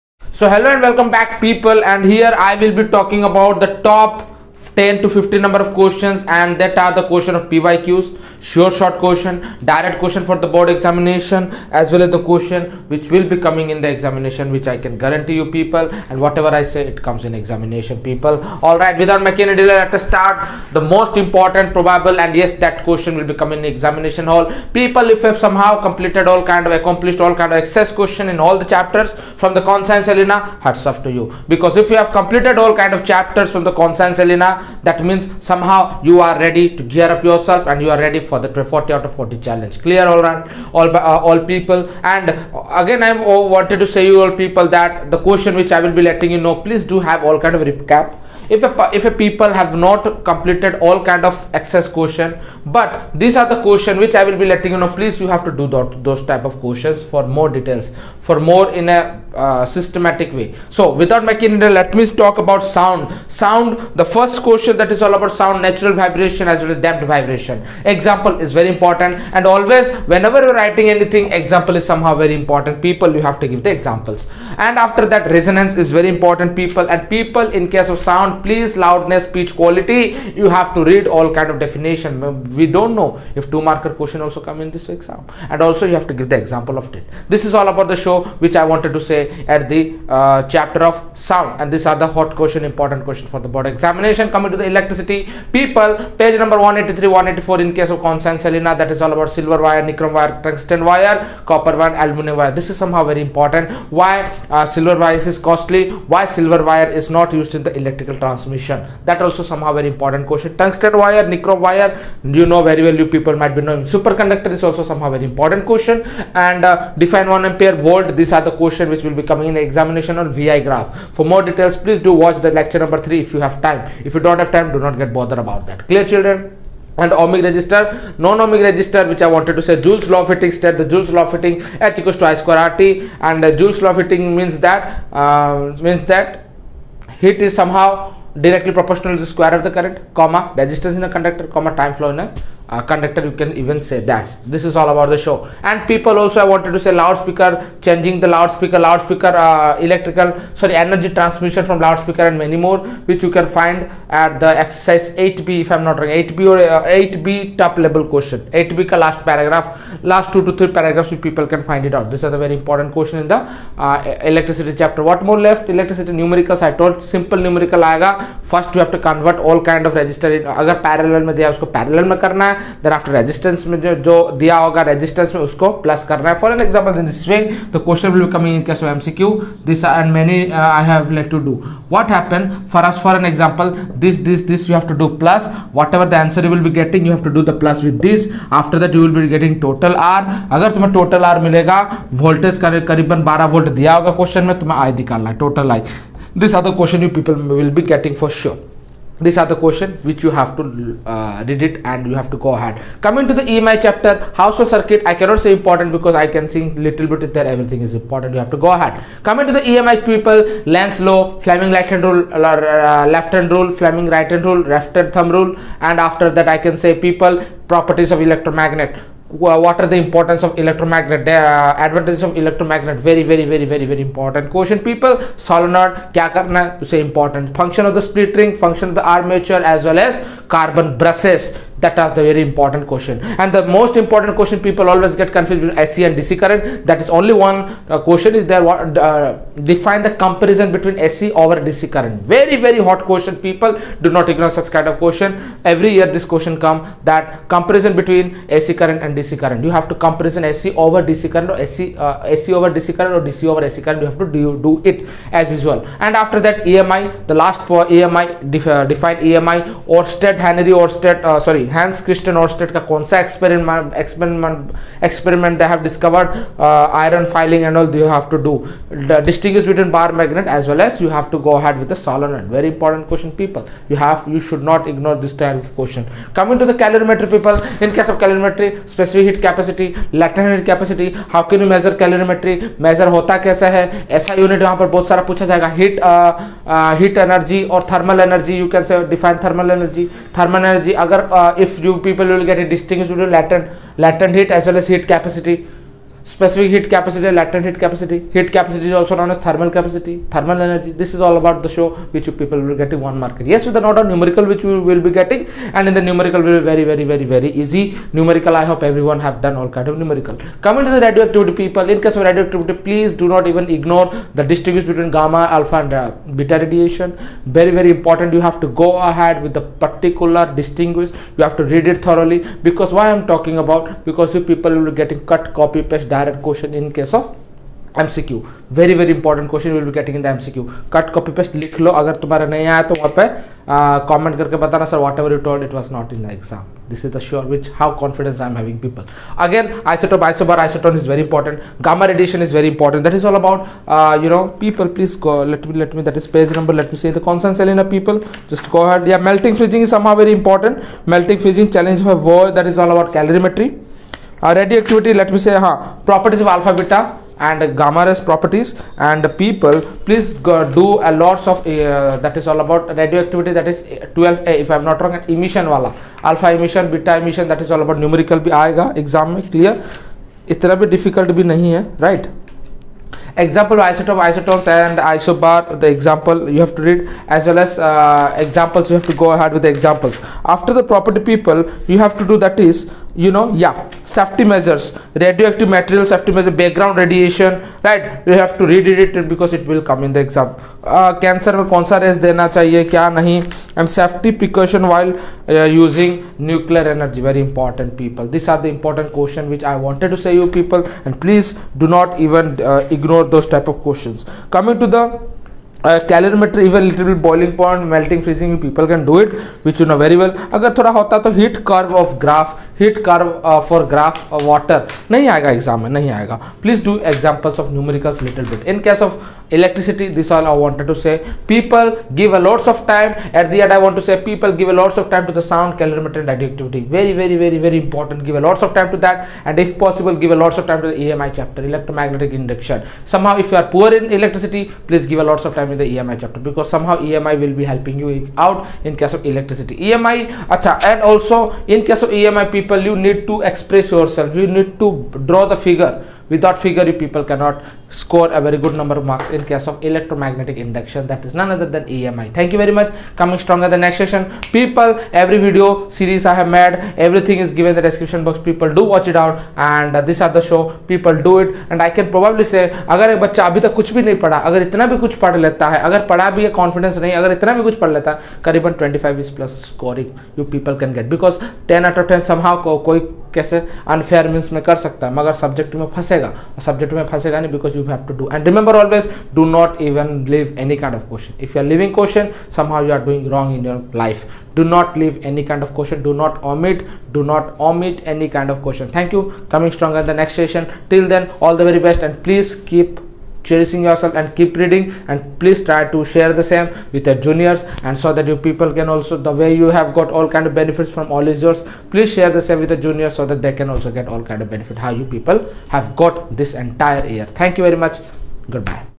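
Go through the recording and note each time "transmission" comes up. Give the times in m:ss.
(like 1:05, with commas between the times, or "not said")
1:48, 2:31.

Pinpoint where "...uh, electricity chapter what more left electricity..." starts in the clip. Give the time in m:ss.
2:43.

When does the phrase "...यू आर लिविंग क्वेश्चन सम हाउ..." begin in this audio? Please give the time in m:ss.
8:01.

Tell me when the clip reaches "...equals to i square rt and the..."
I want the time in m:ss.
2:12.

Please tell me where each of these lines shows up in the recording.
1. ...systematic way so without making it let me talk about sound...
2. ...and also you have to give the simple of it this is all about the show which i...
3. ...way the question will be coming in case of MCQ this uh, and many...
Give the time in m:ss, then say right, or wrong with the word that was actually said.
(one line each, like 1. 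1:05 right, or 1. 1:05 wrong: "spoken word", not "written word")
1. 0:59 right
2. 1:25 wrong: "example", not "simple"
3. 2:57 right.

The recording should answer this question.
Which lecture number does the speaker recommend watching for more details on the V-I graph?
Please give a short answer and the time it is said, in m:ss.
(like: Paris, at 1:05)
lecture number 3, at 2:02.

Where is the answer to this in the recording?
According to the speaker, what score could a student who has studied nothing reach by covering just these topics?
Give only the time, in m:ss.
7:48.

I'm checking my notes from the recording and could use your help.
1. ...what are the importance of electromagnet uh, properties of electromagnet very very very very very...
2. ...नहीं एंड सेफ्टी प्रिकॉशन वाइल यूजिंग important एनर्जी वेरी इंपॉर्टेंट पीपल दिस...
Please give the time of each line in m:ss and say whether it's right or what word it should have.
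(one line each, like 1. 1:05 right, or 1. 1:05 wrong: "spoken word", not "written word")
1. 3:39 wrong: "advantages", not "properties"
2. 6:33 right.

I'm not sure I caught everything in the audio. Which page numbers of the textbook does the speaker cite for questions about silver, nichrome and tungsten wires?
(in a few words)
183 184.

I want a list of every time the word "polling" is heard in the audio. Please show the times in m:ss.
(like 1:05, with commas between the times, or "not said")
not said.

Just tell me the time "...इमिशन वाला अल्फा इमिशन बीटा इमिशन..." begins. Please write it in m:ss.
6:05.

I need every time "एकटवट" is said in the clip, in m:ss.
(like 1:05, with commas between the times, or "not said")
5:54, 6:03.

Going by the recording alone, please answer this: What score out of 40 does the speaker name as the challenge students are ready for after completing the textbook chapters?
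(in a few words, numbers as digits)
40 out of 40.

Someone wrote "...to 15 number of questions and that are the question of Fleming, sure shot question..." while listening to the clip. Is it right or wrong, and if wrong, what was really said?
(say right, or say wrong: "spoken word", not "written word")
wrong: "PYQs", not "Fleming".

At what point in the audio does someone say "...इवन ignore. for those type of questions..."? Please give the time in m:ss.
6:42.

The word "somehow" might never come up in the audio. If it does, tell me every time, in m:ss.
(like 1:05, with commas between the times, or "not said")
0:25, 0:35, 1:11, 1:42, 1:49, 1:54, 2:17, 7:52.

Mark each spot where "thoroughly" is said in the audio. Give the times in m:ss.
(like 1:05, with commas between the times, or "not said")
5:22.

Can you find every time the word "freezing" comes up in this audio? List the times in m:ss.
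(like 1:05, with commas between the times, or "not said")
6:48.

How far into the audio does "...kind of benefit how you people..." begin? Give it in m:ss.
8:24.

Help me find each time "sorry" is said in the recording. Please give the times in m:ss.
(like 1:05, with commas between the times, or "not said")
2:30, 4:21.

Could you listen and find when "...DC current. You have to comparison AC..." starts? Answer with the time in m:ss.
4:09.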